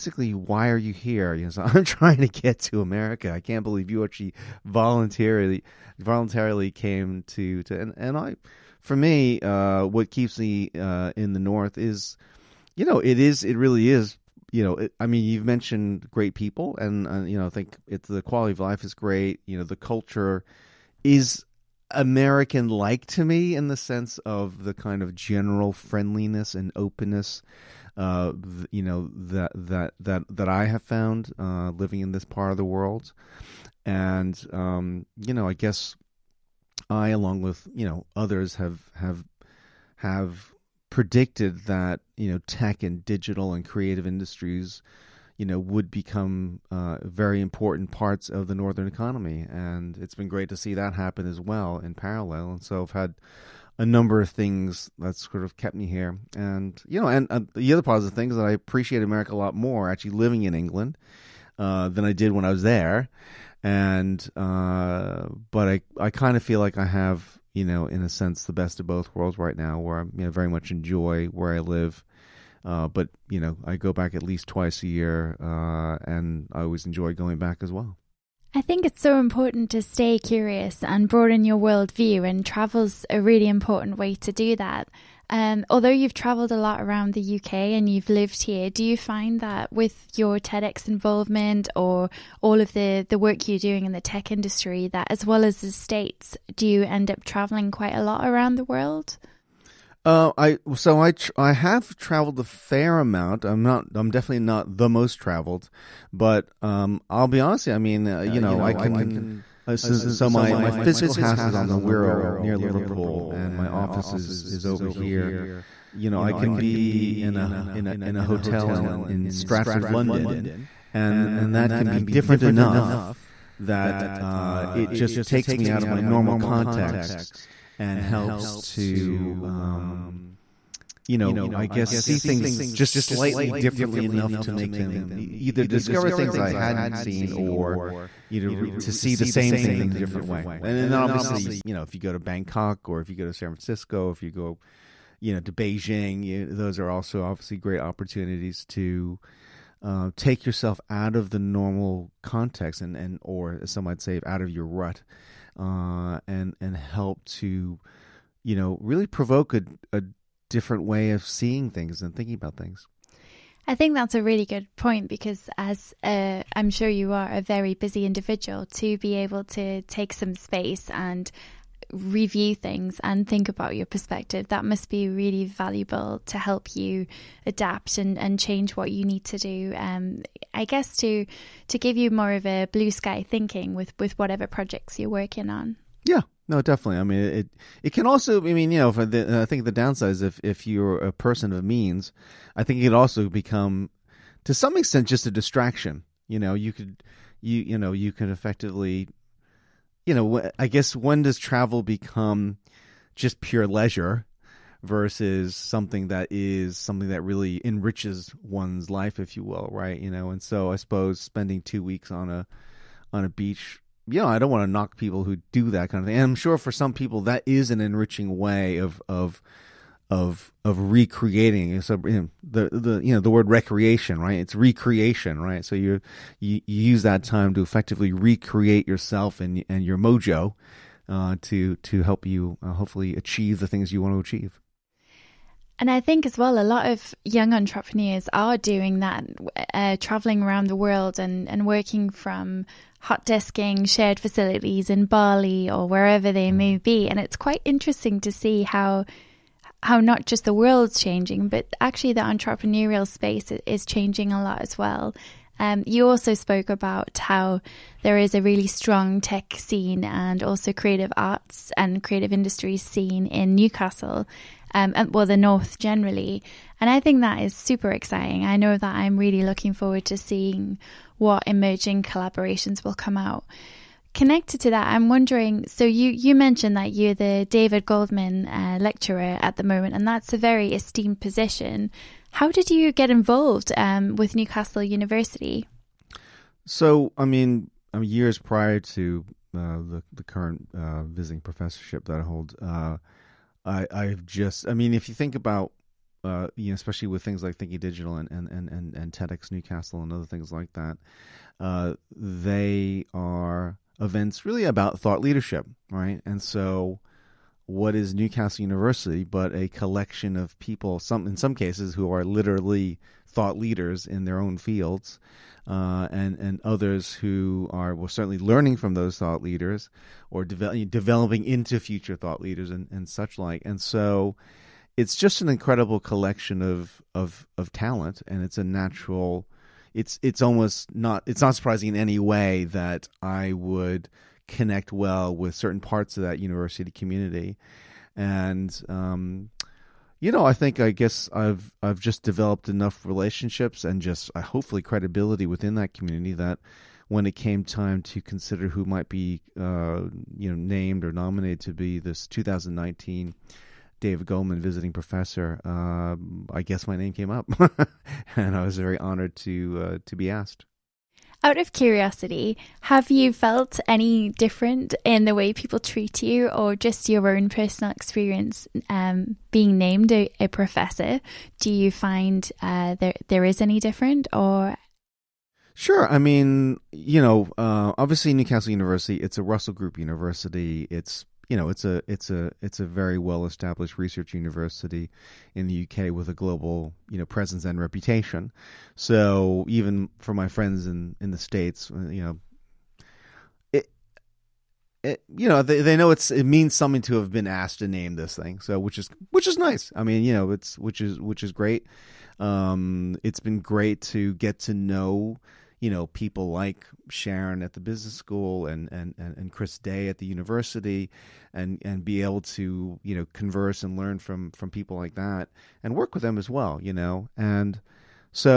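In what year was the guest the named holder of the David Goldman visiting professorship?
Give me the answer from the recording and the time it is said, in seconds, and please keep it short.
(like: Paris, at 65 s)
2019, at 352 s.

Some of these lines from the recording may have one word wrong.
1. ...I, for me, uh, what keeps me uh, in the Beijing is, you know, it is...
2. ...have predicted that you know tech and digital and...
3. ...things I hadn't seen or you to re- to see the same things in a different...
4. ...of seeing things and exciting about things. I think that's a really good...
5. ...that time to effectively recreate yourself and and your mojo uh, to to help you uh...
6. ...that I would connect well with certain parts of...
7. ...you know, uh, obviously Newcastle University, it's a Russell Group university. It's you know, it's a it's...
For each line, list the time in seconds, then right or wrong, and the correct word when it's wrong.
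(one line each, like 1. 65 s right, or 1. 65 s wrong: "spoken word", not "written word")
1. 8 s wrong: "North", not "Beijing"
2. 39 s right
3. 136 s right
4. 161 s wrong: "thinking", not "exciting"
5. 227 s right
6. 332 s right
7. 376 s right.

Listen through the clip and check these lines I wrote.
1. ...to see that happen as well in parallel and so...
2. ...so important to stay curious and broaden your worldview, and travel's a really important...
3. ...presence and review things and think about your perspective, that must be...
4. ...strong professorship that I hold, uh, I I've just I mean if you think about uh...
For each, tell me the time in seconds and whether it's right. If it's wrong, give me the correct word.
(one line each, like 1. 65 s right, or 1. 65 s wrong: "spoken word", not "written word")
1. 50 s right
2. 79 s right
3. 170 s wrong: "space", not "presence"
4. 291 s wrong: "visiting", not "strong".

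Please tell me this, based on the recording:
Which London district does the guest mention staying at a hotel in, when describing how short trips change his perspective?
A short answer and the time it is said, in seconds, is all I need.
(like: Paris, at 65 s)
Stratford, at 119 s.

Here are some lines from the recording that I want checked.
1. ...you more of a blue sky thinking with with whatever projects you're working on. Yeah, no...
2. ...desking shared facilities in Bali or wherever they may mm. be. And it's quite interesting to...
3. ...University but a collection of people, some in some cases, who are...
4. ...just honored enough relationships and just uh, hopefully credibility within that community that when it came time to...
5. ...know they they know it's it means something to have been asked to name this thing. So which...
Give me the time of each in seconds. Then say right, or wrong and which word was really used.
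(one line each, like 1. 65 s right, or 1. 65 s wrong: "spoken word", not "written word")
1. 181 s right
2. 243 s right
3. 308 s right
4. 341 s wrong: "developed", not "honored"
5. 395 s right.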